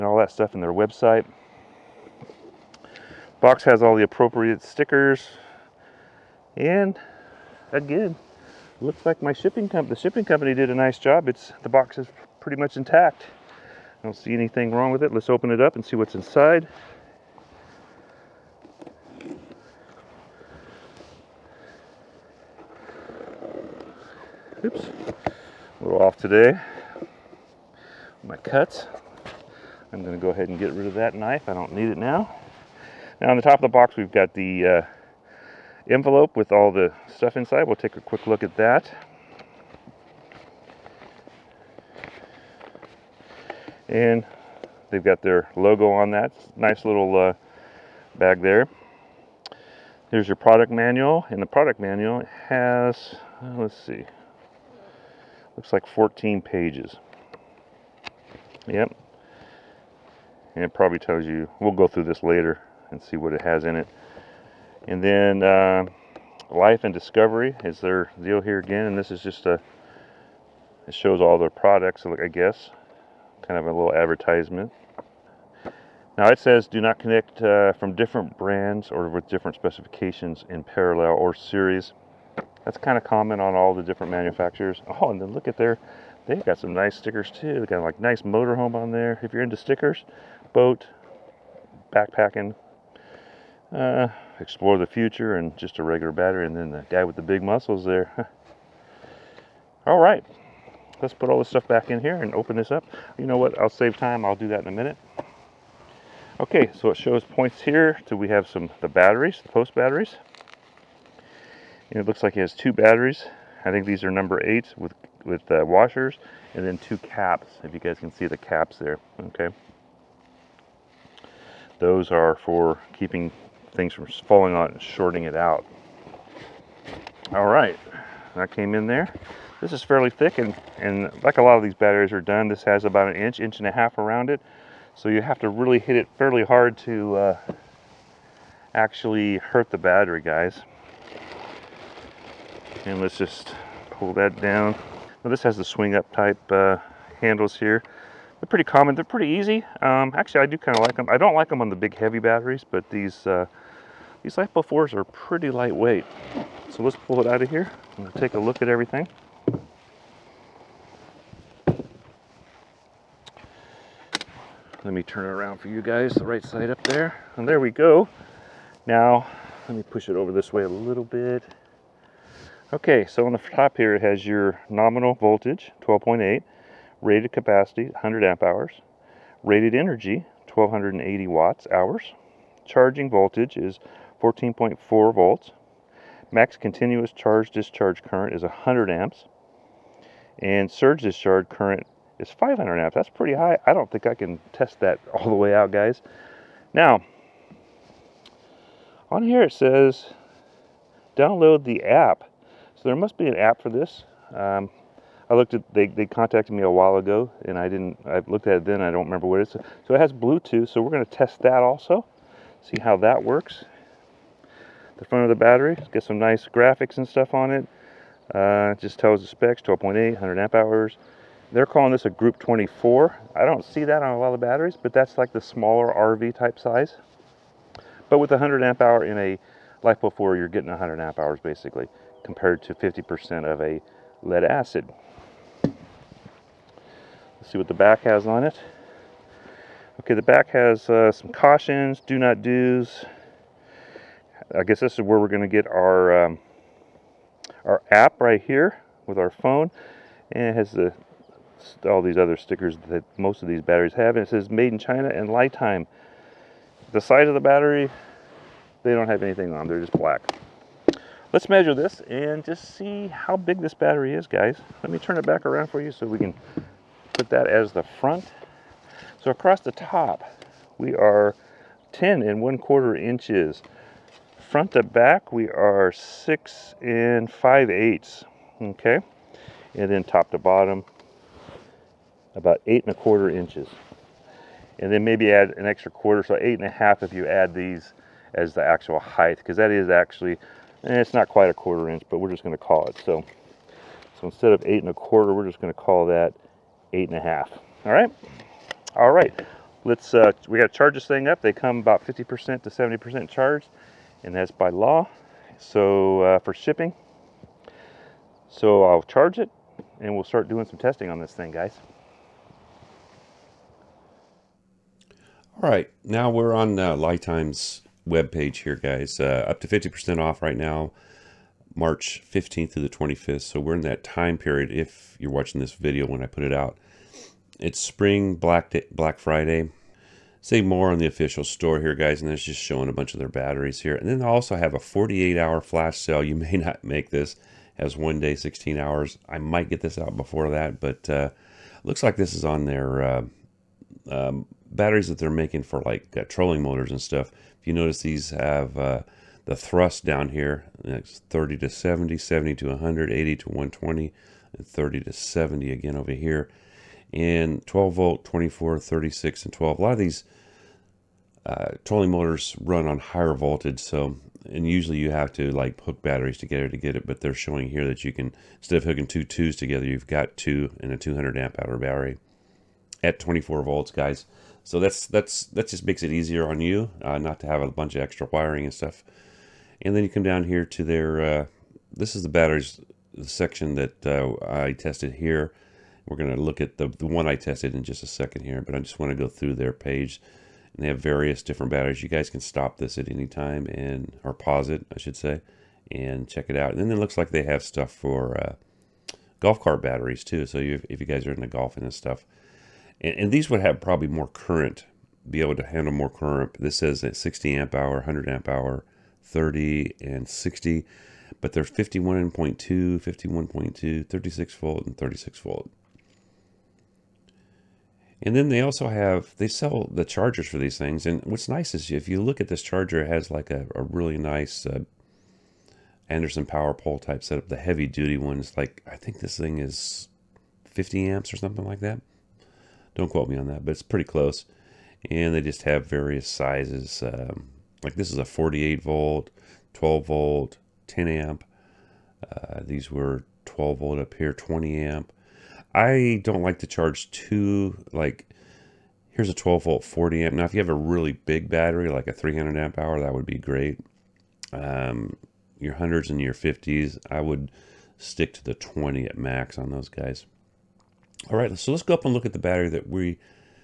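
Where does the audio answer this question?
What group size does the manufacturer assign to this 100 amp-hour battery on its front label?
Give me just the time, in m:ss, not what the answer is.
3:42.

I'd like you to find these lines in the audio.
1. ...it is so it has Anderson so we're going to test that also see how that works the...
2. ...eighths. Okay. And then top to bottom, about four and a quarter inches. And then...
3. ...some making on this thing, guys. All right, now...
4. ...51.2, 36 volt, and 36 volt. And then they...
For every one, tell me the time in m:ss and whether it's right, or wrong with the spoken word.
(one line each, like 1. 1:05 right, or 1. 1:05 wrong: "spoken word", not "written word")
1. 3:29 wrong: "Bluetooth", not "Anderson"
2. 4:37 wrong: "eight", not "four"
3. 5:10 wrong: "testing", not "making"
4. 6:53 right.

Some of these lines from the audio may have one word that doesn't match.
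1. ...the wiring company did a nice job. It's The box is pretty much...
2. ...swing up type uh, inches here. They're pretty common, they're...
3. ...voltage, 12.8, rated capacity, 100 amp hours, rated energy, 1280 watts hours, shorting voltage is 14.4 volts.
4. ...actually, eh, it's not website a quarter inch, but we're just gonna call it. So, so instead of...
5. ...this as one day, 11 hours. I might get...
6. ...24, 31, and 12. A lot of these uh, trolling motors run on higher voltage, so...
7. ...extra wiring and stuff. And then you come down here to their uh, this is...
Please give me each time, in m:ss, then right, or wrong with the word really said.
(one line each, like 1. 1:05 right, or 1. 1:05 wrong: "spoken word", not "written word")
1. 0:09 wrong: "shipping", not "wiring"
2. 2:25 wrong: "handles", not "inches"
3. 2:55 wrong: "charging", not "shorting"
4. 4:49 wrong: "quite", not "website"
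5. 5:37 wrong: "16", not "11"
6. 5:58 wrong: "36", not "31"
7. 6:18 right.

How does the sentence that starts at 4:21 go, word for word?
Let's measure this and just see how big this battery is, guys.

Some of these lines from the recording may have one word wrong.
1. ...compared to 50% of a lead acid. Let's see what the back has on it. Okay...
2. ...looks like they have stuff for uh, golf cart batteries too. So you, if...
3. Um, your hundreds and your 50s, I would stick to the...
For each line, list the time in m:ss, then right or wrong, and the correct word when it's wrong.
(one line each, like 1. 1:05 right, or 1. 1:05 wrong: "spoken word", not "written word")
1. 3:52 right
2. 6:37 right
3. 7:34 right.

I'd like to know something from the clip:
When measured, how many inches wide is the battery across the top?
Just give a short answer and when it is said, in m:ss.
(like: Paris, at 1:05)
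10 1/4 inches, at 4:31.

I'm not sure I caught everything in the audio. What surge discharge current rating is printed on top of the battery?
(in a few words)
500 amps.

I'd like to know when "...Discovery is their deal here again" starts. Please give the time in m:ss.
1:06.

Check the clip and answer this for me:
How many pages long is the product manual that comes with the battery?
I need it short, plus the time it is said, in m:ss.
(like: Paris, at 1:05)
14, at 0:55.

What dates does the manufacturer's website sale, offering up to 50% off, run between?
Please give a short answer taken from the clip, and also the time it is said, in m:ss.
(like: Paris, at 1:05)
March 15th to 25th, at 5:21.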